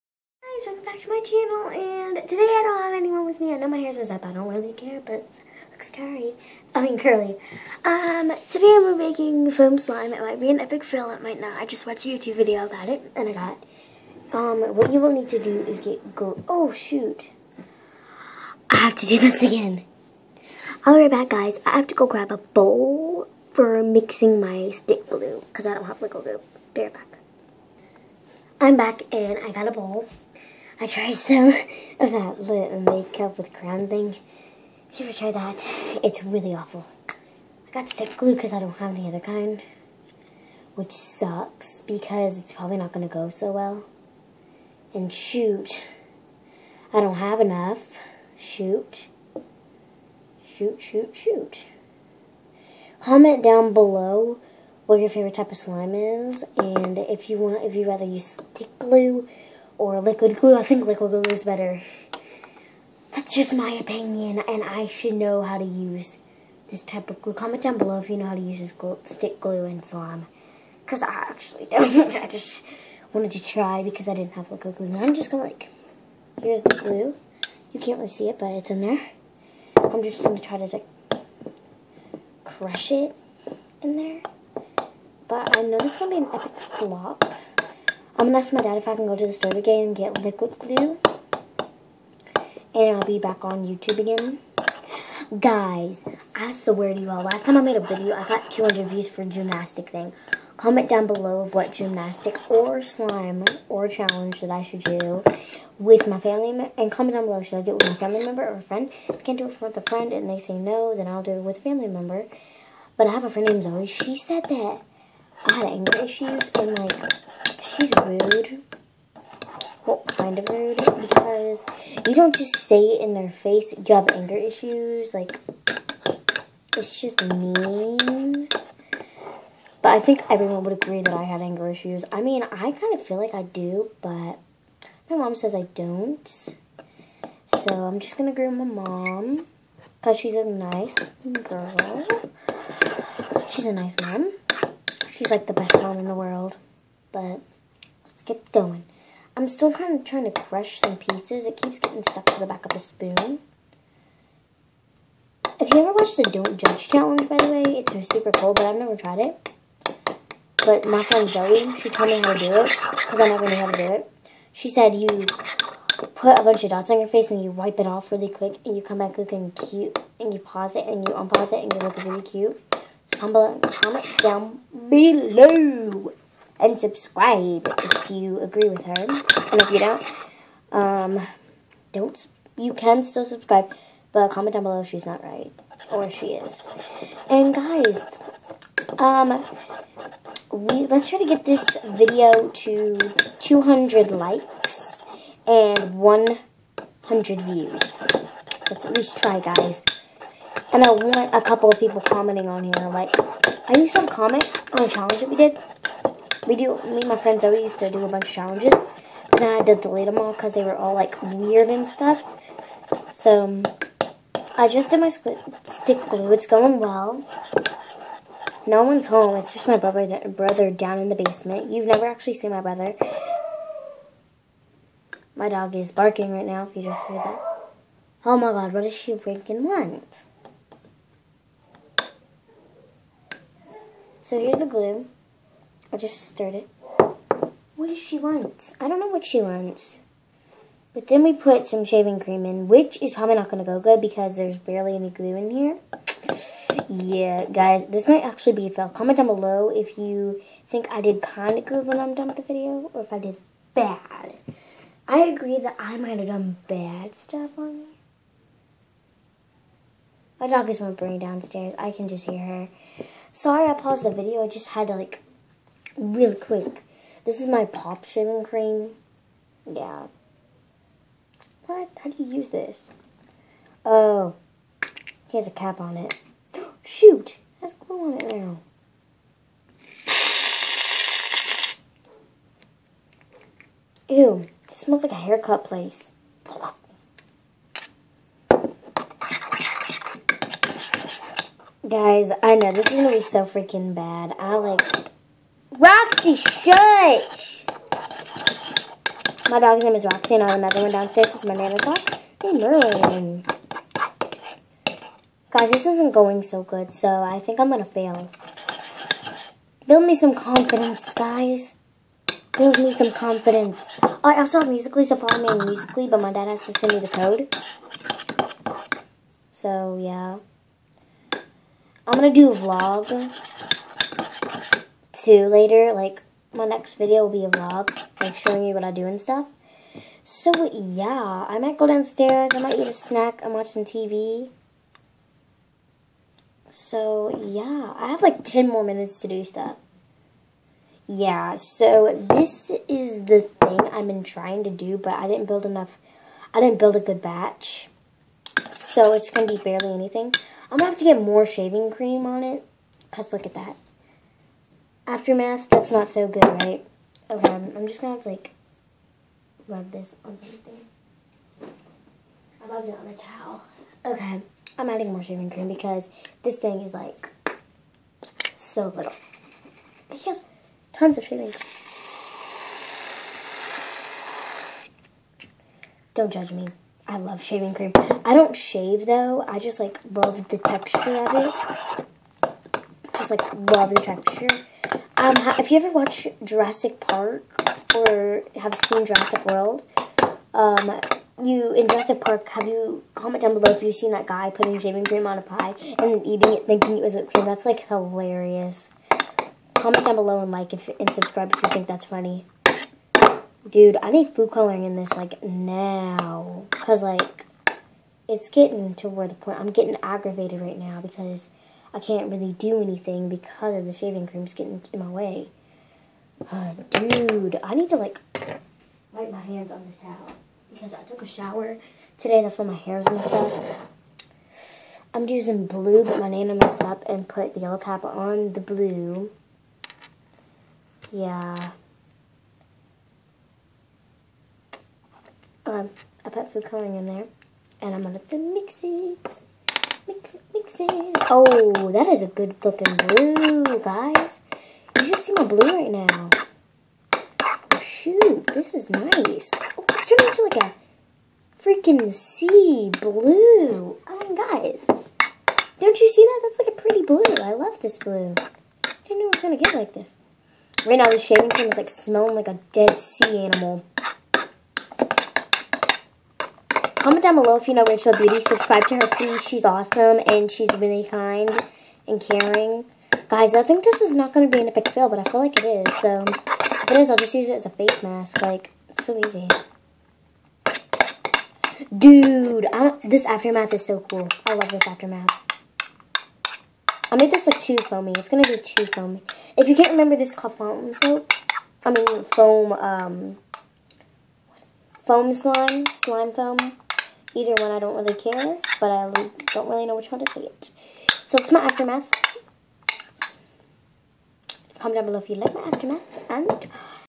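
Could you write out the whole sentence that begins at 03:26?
We do, me and my friends always used to do a bunch of challenges.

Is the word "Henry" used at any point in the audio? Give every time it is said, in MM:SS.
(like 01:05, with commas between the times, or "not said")
not said.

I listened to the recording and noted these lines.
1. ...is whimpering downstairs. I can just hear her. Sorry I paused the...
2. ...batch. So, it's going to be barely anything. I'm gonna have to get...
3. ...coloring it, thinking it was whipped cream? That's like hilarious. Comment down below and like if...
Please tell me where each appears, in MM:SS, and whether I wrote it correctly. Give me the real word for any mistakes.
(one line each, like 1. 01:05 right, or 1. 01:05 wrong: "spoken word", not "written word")
1. 04:20 right
2. 05:47 right
3. 06:36 wrong: "eating", not "coloring".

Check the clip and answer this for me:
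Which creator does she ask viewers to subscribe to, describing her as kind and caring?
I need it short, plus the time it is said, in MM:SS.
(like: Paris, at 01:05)
Rachel Beauty, at 07:47.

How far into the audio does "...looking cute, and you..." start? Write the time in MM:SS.
02:49.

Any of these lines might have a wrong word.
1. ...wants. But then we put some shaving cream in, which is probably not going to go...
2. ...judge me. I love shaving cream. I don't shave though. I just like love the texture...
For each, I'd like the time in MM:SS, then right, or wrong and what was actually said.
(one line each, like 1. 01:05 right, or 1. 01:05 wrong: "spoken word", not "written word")
1. 03:59 right
2. 06:16 right.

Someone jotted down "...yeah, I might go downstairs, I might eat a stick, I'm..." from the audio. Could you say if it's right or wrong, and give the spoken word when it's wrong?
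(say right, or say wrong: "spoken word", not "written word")
wrong: "snack", not "stick".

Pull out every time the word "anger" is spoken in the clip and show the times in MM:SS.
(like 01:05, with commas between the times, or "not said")
01:55, 02:04, 02:11.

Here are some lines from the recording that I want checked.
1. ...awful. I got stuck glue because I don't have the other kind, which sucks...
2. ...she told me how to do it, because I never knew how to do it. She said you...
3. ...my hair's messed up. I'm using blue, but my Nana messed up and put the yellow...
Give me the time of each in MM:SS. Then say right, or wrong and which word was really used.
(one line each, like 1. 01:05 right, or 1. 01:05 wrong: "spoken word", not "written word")
1. 00:36 wrong: "stick", not "stuck"
2. 02:41 right
3. 07:02 right.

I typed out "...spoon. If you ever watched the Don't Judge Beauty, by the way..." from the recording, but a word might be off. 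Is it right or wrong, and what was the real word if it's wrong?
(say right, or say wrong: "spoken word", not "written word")
wrong: "Challenge", not "Beauty".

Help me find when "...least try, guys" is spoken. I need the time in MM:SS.
03:18.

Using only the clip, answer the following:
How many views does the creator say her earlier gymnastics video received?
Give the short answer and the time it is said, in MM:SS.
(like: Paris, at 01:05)
200, at 01:38.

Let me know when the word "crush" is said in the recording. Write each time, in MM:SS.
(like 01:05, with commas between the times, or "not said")
01:22, 02:30.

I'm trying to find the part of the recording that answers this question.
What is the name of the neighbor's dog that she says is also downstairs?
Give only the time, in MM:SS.
05:02.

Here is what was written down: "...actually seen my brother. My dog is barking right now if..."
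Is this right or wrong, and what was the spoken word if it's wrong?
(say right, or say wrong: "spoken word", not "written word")
right.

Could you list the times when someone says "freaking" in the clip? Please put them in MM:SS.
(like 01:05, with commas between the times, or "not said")
04:53, 07:31.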